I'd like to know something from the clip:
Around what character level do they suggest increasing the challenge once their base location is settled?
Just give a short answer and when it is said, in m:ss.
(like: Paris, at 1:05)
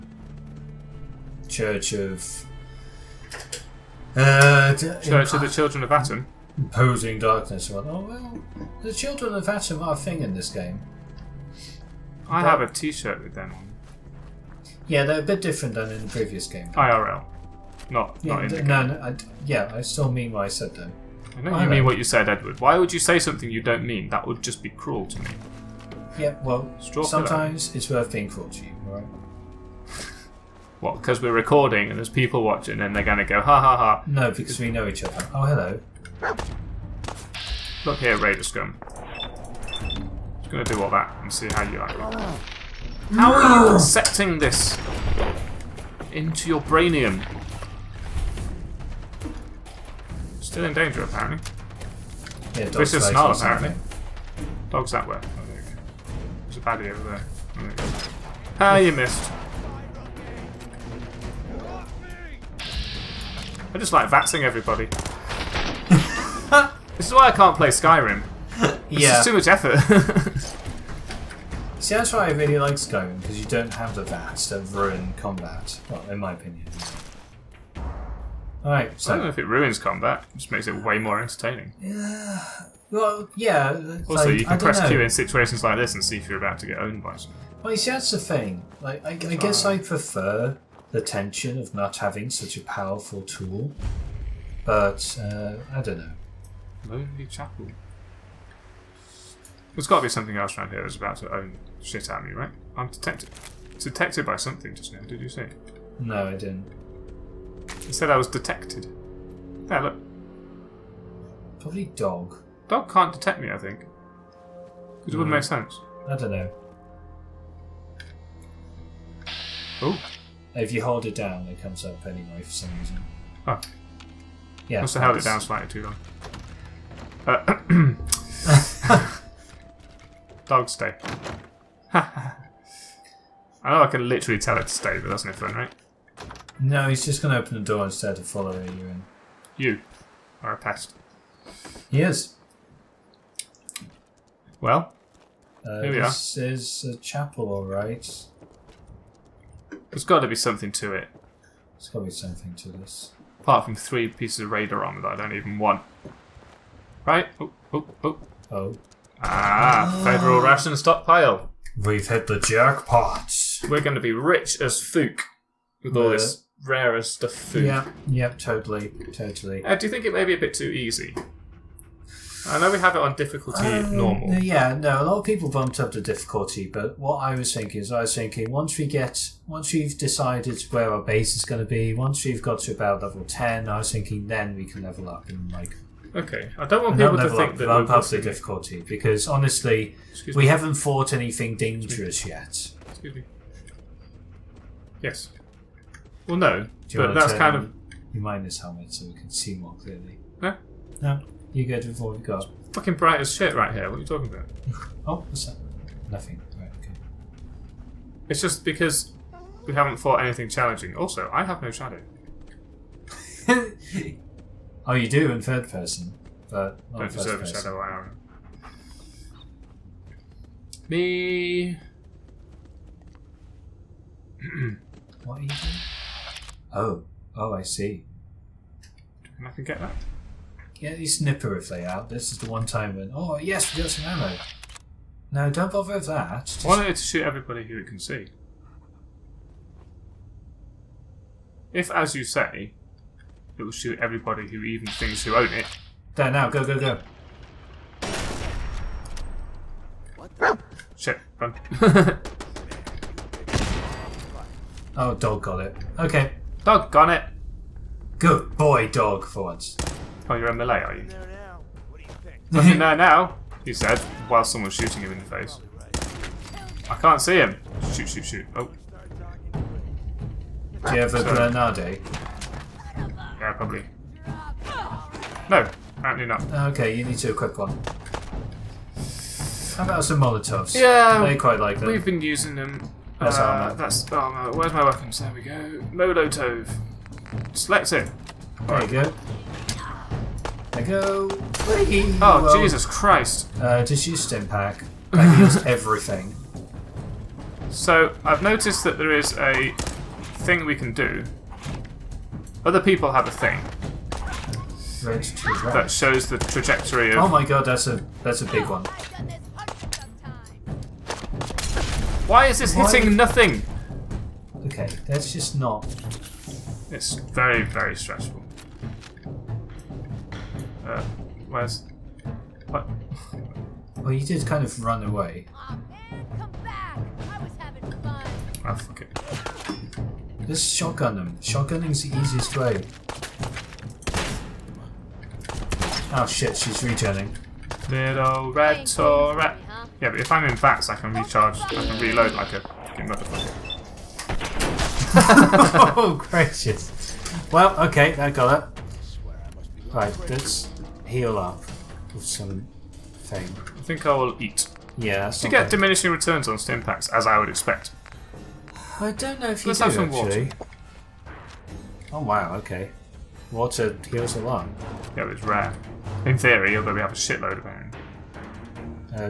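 Level 10, at 3:03.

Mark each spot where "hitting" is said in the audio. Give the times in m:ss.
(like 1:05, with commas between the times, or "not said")
5:12.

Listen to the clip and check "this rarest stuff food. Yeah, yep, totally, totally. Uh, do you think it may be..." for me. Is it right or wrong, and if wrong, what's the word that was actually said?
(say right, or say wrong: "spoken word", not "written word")
right.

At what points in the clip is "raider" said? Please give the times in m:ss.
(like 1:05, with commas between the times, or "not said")
0:38, 2:34.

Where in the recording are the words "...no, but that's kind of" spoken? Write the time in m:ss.
3:16.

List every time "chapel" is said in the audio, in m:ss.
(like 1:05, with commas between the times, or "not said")
1:37, 2:26.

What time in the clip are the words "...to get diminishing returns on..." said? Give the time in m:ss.
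5:55.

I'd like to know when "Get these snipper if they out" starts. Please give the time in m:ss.
3:50.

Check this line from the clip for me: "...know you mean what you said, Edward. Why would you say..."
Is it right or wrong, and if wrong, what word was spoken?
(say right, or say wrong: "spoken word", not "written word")
right.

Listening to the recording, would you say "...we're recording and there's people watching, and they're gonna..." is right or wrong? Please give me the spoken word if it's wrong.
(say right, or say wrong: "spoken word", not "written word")
right.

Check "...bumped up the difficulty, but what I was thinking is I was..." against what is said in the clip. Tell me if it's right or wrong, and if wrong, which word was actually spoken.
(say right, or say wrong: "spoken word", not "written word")
right.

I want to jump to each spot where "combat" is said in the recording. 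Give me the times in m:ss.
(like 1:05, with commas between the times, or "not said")
1:15, 1:19.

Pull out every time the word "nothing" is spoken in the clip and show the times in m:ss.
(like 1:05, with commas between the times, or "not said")
3:26, 4:22, 5:13.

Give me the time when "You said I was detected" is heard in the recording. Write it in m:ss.
1:47.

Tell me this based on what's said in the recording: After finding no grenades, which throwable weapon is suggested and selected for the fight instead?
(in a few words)
Molotovs.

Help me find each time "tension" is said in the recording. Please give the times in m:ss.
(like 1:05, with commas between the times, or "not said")
1:31.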